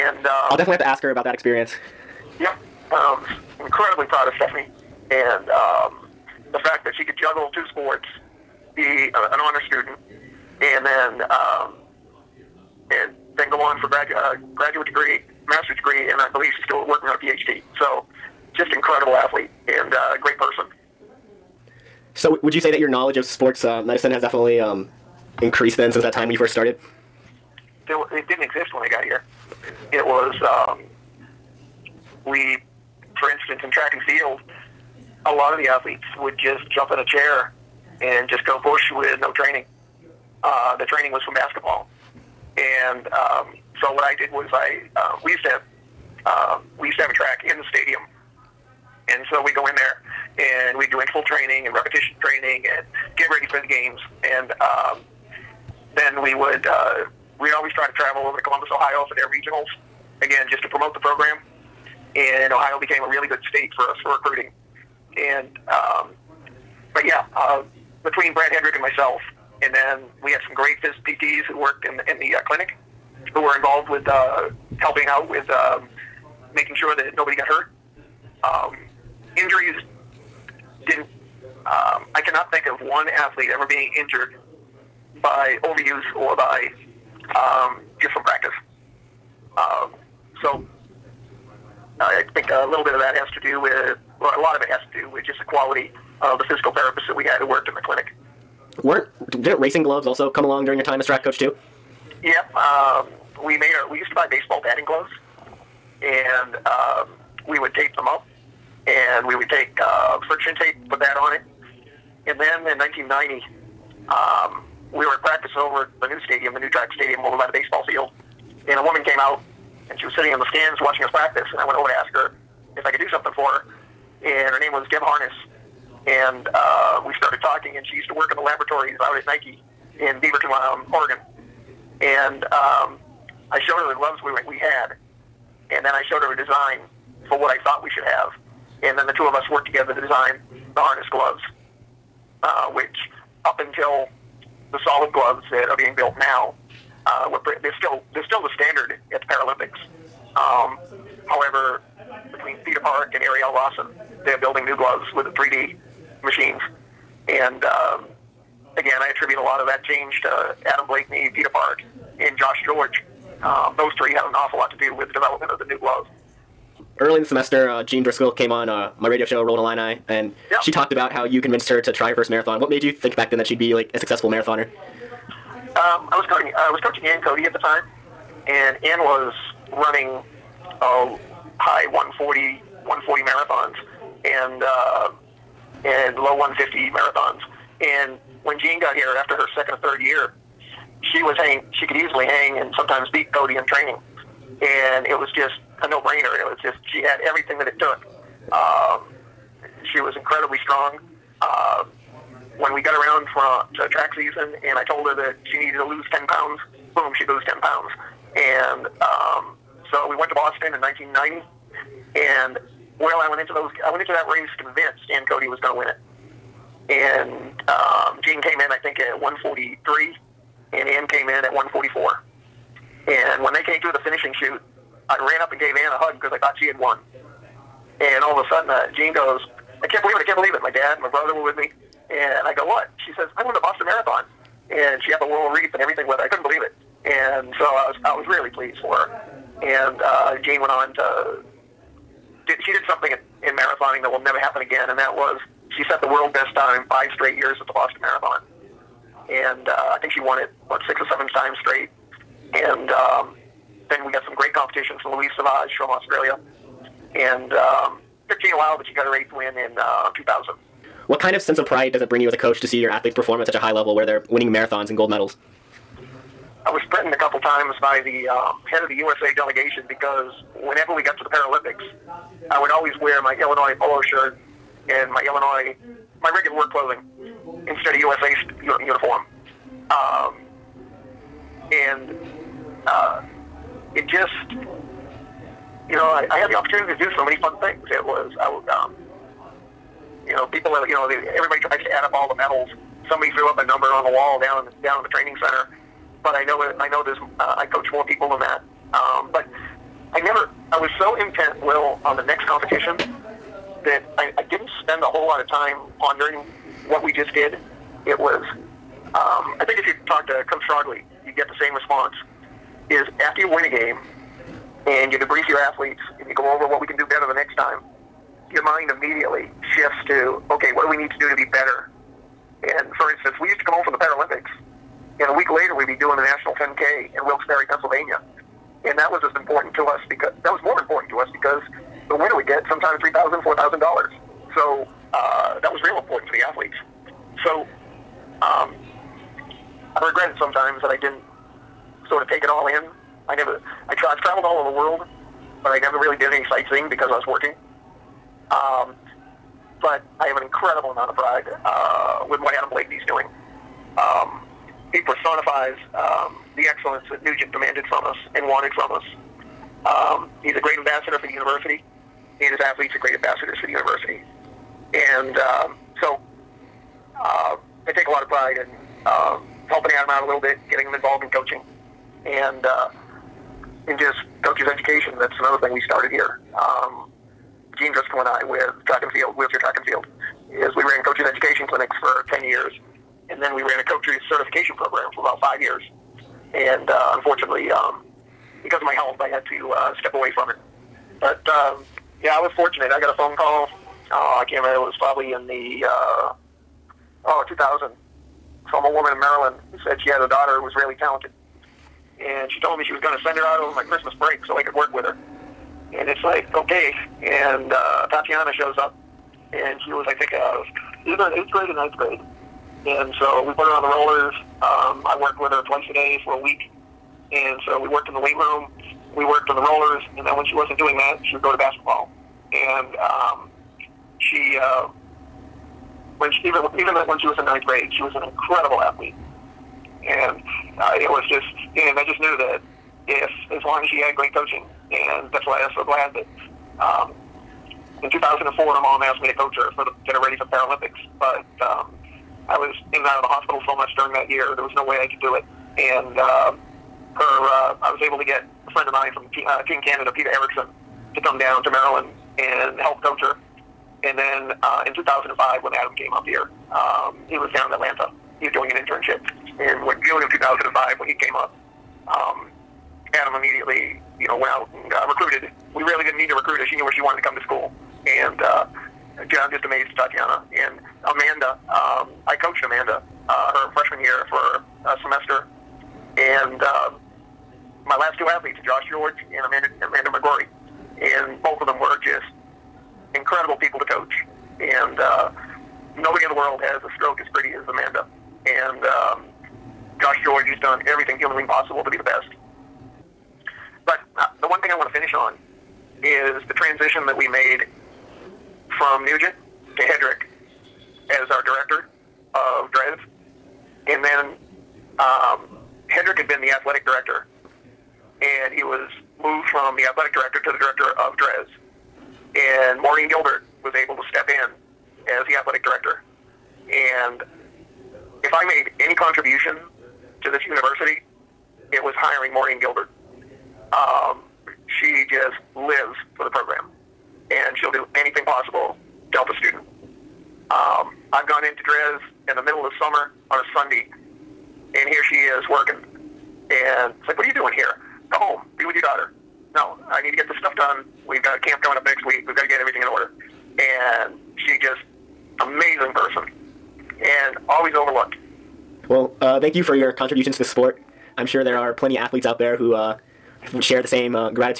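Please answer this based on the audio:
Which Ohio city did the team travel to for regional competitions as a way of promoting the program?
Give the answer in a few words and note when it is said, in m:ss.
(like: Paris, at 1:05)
Columbus, at 0:58.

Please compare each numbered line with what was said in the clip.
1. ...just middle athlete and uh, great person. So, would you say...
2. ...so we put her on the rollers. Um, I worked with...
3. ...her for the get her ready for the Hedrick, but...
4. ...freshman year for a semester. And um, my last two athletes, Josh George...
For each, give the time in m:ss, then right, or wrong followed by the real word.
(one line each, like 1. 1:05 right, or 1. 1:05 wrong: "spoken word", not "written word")
1. 0:18 wrong: "incredible", not "middle"
2. 6:53 right
3. 7:19 wrong: "Paralympics", not "Hedrick"
4. 7:53 right.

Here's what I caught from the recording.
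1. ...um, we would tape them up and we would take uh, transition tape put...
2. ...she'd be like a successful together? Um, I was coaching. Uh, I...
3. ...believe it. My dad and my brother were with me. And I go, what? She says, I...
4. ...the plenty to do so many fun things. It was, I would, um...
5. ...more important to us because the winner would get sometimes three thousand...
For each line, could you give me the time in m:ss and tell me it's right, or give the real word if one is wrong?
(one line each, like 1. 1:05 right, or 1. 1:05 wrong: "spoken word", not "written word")
1. 1:46 wrong: "friction", not "transition"
2. 2:53 wrong: "marathoner", not "together"
3. 3:50 right
4. 4:46 wrong: "opportunity", not "plenty"
5. 5:30 right.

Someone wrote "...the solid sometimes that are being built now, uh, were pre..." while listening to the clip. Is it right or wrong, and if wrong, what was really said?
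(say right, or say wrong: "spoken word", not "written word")
wrong: "gloves", not "sometimes".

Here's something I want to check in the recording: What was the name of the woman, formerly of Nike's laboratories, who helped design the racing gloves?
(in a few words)
Deb Harness.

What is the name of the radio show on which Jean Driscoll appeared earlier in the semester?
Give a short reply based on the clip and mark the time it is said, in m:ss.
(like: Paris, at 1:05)
Rolling Illini, at 2:49.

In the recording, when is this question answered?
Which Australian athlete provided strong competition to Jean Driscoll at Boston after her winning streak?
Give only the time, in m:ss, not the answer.
4:15.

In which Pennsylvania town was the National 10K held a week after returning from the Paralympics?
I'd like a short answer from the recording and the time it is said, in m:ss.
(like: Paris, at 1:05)
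Wilkes-Barre, at 5:27.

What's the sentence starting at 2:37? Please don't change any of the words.
And uh, again, I attribute a lot of that change to Adam Bleakney, Peter Park, and Josh George.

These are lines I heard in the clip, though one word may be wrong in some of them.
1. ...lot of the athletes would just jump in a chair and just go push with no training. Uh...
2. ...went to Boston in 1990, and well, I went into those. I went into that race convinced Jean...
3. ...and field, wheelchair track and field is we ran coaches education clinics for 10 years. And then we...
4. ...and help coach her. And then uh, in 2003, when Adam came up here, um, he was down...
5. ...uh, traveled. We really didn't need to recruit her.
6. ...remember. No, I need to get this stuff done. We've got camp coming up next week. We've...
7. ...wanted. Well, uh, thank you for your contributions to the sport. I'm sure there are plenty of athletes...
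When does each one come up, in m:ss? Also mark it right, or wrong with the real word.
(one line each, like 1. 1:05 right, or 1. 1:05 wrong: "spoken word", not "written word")
1. 0:35 right
2. 3:30 wrong: "Dan", not "Jean"
3. 6:19 right
4. 7:32 wrong: "2005", not "2003"
5. 7:44 wrong: "recruited", not "traveled"
6. 8:58 wrong: "daughter", not "remember"
7. 9:07 wrong: "overlooked", not "wanted".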